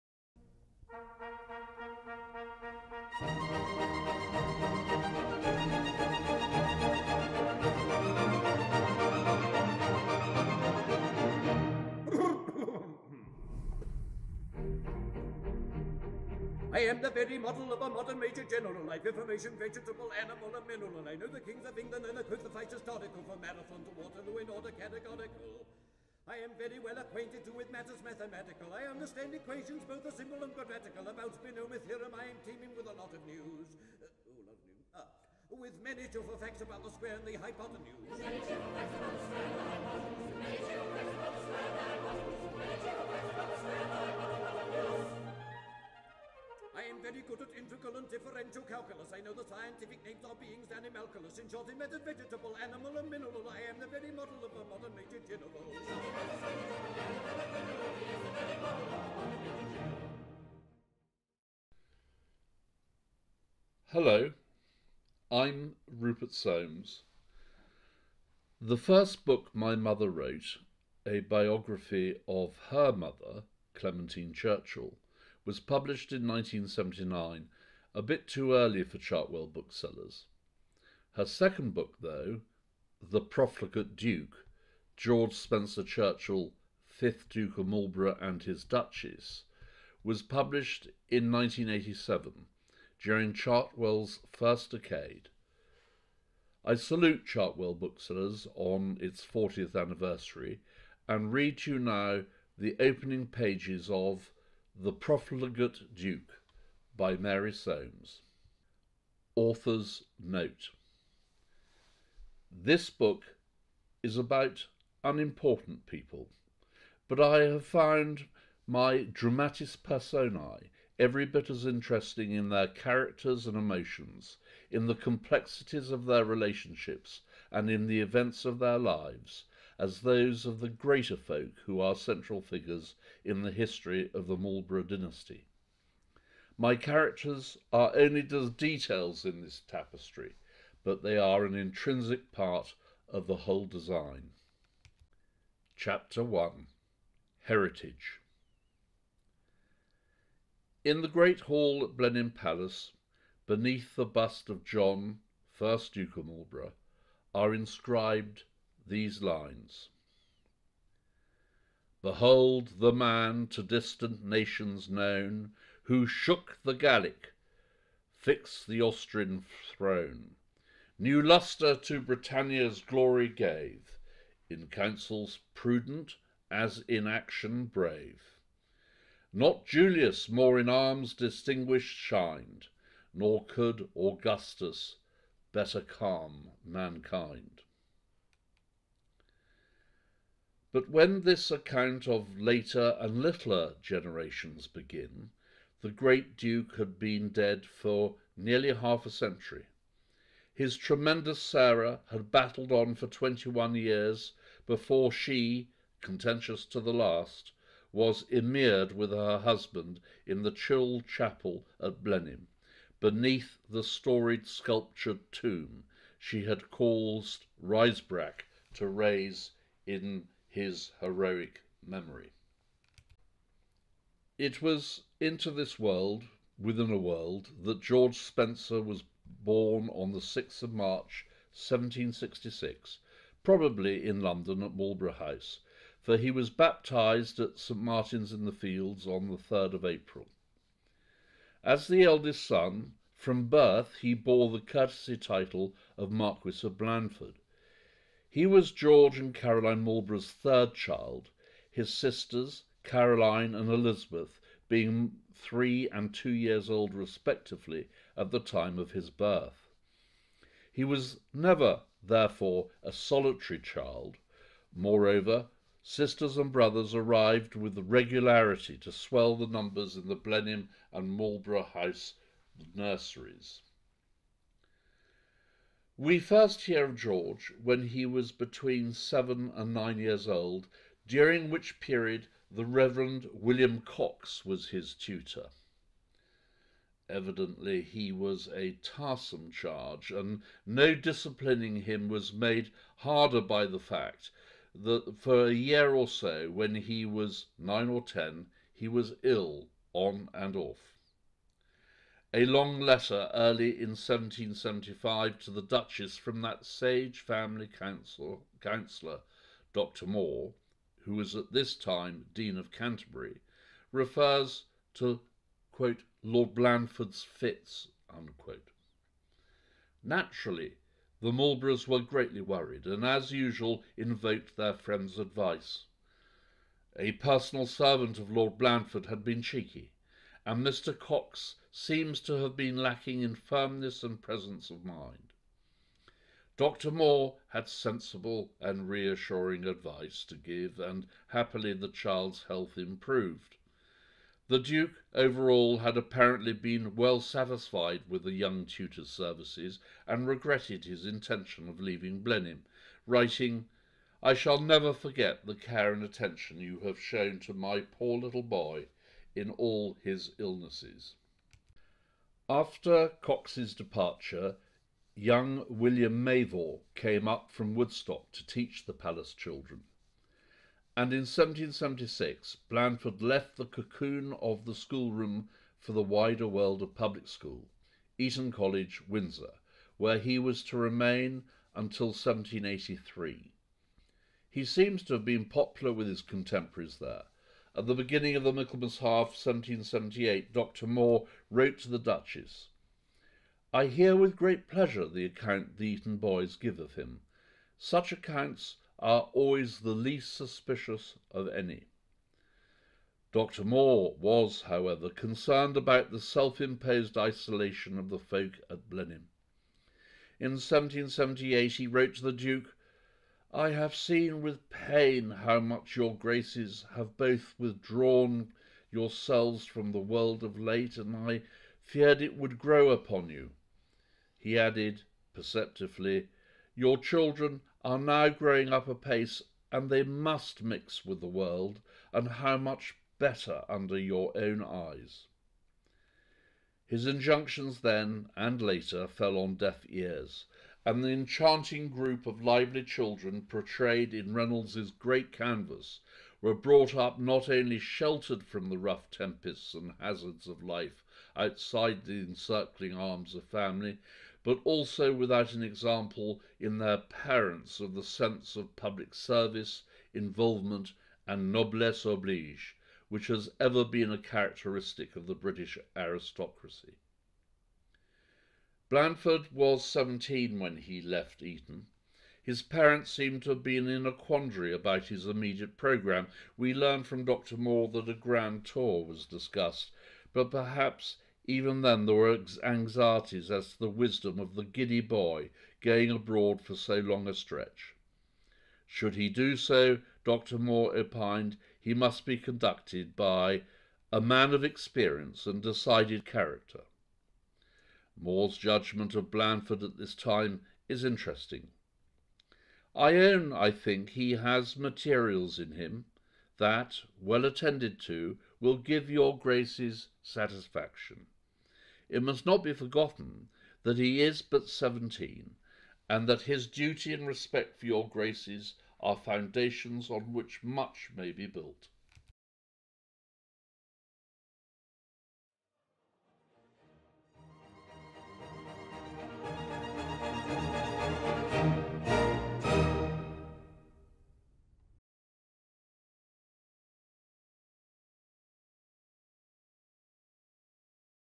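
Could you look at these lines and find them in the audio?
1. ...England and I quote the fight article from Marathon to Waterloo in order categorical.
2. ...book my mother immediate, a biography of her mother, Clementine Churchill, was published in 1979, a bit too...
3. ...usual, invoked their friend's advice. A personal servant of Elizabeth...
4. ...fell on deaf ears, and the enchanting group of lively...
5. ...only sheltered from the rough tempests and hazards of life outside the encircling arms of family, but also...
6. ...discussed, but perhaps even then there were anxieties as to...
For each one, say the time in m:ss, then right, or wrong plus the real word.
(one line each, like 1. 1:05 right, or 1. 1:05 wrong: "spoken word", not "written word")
1. 0:21 right
2. 1:09 wrong: "wrote", not "immediate"
3. 5:23 wrong: "Lord", not "Elizabeth"
4. 7:19 right
5. 7:27 right
6. 7:59 right.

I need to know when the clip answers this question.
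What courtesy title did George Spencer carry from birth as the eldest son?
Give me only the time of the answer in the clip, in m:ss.
4:06.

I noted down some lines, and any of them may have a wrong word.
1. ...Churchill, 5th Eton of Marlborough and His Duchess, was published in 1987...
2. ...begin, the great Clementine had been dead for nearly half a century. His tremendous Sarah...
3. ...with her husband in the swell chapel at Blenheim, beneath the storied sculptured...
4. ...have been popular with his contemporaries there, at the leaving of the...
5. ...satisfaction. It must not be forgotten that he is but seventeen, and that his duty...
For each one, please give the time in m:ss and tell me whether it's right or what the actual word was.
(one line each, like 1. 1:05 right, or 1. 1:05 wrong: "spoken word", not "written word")
1. 1:25 wrong: "Duke", not "Eton"
2. 3:14 wrong: "Duke", not "Clementine"
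3. 3:28 wrong: "chill", not "swell"
4. 6:25 wrong: "beginning", not "leaving"
5. 8:30 right.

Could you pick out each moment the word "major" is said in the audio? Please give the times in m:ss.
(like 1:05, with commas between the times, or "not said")
0:18, 0:54.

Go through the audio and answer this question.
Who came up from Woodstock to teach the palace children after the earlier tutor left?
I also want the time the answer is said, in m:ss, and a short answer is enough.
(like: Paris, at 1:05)
William Mavor, at 6:05.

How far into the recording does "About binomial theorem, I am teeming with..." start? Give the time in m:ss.
0:31.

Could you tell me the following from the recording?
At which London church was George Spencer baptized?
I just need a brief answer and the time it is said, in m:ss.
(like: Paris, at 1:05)
St. Martin's in the Fields, at 3:57.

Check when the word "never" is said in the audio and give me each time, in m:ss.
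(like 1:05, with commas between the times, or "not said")
4:21, 5:54.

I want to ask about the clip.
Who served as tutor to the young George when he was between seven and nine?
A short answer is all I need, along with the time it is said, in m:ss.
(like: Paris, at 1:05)
William Cox, at 4:43.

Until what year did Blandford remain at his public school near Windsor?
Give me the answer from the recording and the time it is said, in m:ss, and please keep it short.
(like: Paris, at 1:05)
1783, at 6:22.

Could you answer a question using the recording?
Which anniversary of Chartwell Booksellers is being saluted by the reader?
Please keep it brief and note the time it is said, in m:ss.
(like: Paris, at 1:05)
40th, at 1:39.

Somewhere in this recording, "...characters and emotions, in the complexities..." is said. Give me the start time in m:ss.
2:02.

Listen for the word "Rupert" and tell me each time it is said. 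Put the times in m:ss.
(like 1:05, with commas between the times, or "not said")
1:05.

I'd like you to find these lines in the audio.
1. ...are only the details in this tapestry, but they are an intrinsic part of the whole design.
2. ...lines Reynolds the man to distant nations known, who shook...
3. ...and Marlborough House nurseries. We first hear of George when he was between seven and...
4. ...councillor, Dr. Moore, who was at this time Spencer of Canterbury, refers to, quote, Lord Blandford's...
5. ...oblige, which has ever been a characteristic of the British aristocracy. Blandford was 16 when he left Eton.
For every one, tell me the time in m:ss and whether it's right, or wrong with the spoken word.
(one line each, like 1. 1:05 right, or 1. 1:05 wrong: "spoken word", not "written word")
1. 2:17 right
2. 2:39 wrong: "Behold", not "Reynolds"
3. 4:30 right
4. 5:07 wrong: "Dean", not "Spencer"
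5. 7:42 wrong: "17", not "16".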